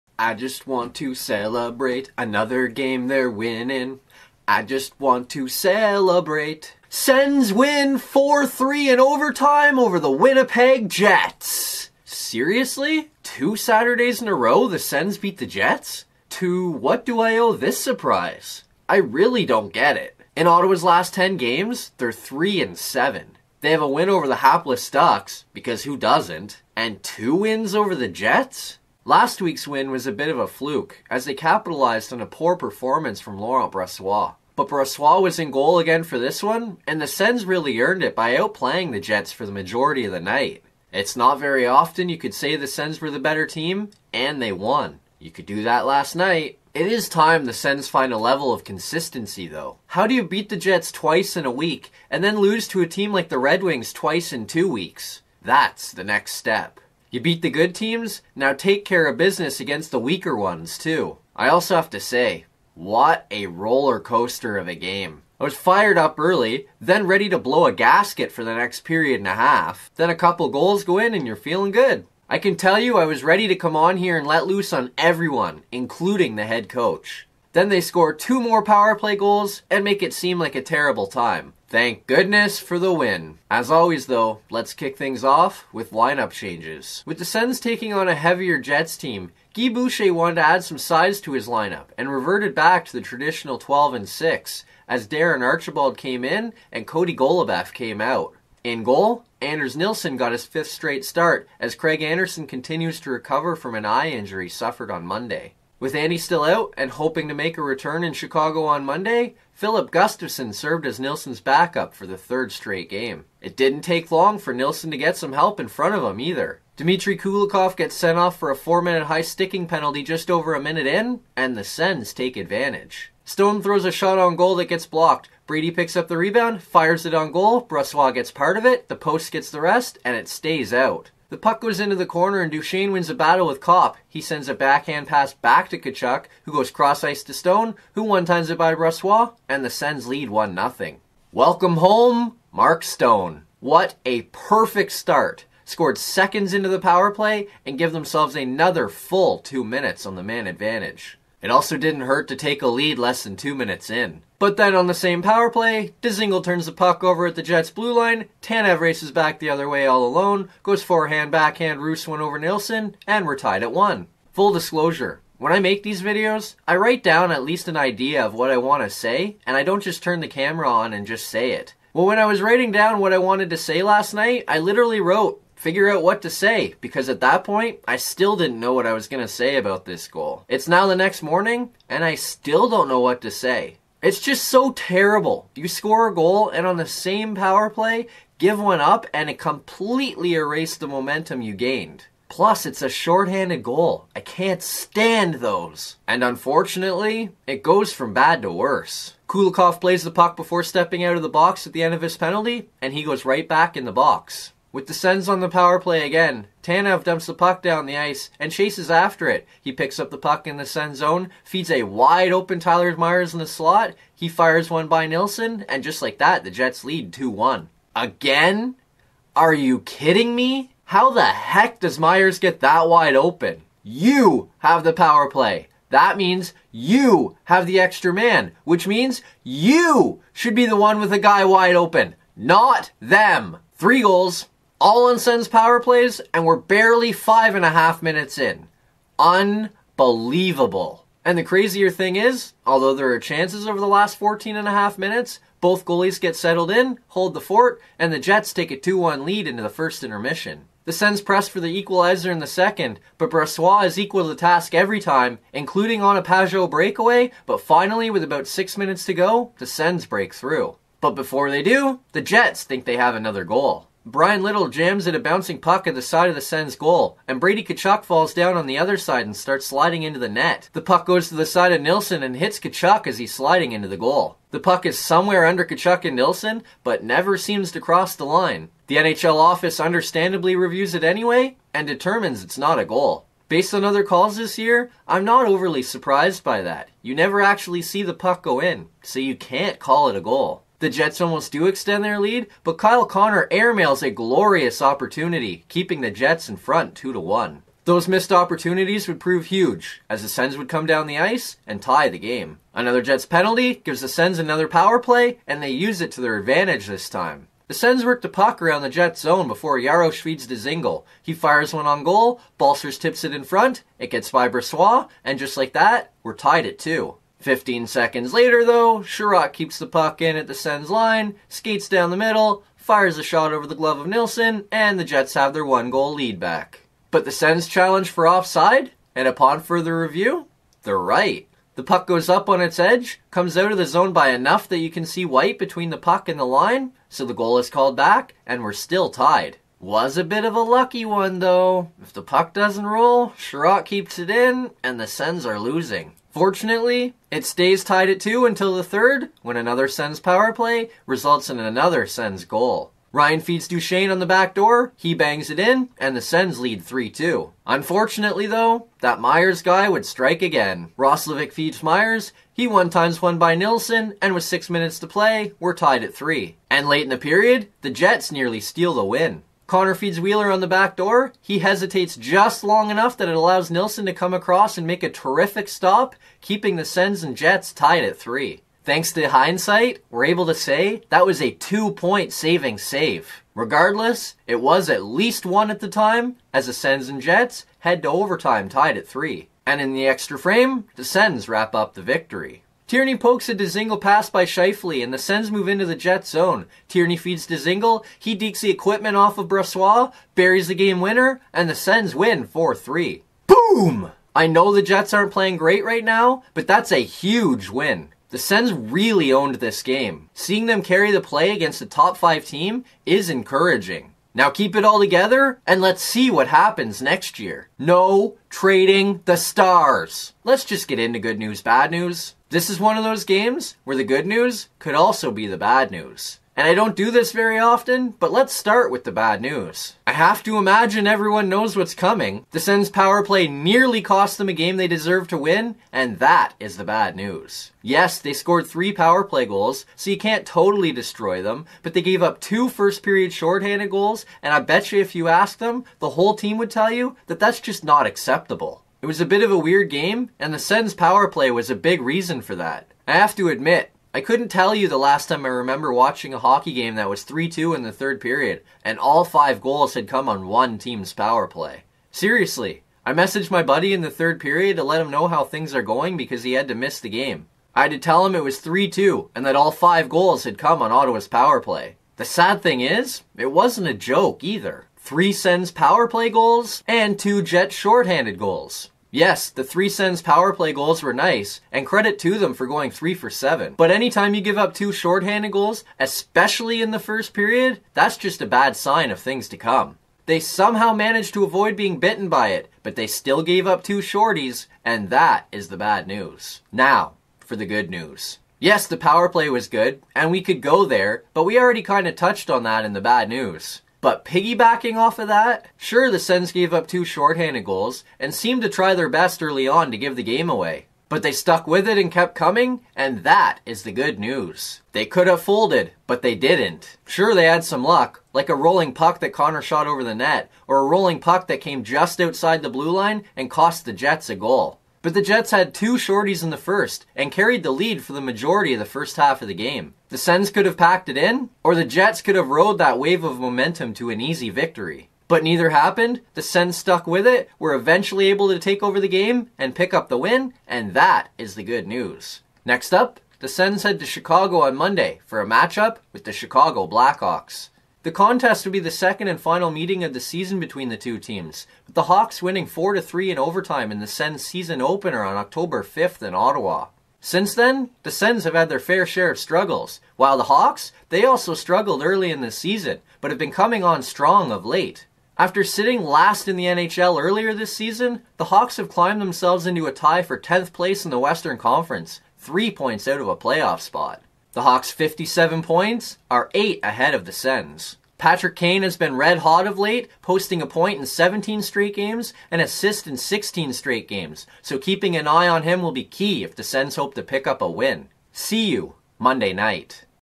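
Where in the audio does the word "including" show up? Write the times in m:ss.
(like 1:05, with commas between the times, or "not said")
1:15, 4:15.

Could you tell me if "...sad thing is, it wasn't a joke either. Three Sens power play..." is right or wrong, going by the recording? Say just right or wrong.
right.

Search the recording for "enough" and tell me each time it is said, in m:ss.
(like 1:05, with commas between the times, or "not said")
5:34, 6:12.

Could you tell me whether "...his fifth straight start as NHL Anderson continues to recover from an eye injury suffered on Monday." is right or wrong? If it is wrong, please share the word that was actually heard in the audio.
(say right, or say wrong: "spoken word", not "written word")
wrong: "Craig", not "NHL".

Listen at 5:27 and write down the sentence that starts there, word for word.
But the Sens challenge for offside, and upon further review, they're right.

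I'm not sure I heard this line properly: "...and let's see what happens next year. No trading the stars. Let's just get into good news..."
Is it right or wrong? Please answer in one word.
right.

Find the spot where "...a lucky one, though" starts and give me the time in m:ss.
5:40.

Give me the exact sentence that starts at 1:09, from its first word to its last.
Then a couple goals go in and you're feeling good.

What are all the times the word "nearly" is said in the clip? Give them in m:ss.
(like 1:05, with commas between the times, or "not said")
6:08, 7:13.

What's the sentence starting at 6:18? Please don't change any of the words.
Thanks to hindsight, we're able to say that was a two point saving save.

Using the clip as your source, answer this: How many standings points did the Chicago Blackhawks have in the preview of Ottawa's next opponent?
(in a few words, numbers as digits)
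57.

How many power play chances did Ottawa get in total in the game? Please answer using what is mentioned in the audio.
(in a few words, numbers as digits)
7.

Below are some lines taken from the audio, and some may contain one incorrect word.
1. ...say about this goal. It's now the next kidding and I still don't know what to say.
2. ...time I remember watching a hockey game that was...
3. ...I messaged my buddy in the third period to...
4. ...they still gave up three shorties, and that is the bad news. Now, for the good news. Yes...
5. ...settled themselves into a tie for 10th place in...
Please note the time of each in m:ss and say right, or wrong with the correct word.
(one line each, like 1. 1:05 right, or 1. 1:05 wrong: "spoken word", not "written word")
1. 2:59 wrong: "morning", not "kidding"
2. 7:35 right
3. 7:43 right
4. 8:12 wrong: "two", not "three"
5. 9:28 wrong: "climbed", not "settled".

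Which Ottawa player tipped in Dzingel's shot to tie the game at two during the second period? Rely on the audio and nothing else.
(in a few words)
Balcers.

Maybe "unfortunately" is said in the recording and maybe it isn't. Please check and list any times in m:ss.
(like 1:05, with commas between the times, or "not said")
3:16, 5:57.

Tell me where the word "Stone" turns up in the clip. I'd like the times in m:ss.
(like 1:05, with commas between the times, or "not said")
2:03, 2:17, 2:22.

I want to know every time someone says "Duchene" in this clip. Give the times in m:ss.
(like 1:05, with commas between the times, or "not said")
2:12, 5:53.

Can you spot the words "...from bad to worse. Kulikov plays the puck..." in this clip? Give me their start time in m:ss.
3:17.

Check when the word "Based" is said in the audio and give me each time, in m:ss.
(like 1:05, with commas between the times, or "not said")
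4:43.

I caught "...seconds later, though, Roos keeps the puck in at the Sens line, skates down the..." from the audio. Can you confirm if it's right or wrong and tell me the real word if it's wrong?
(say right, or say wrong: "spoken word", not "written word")
wrong: "Sherratt", not "Roos".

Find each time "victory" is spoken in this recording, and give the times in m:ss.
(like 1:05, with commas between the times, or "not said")
6:32, 8:54.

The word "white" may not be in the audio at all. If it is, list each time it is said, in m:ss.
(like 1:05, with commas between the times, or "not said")
5:35.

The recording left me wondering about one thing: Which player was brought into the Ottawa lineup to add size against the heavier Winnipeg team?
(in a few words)
Darren Archibald.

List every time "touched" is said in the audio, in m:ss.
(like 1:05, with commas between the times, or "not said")
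8:22.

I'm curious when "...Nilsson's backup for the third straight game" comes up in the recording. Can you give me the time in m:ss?
1:50.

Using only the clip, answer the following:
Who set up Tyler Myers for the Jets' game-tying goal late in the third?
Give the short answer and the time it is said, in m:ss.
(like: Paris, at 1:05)
Roslovic, at 6:00.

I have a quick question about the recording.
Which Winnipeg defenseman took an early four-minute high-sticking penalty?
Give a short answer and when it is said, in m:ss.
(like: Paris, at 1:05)
Dmitry Kulikov, at 1:56.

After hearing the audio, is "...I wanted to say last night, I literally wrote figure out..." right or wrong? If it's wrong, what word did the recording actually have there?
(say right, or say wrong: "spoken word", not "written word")
right.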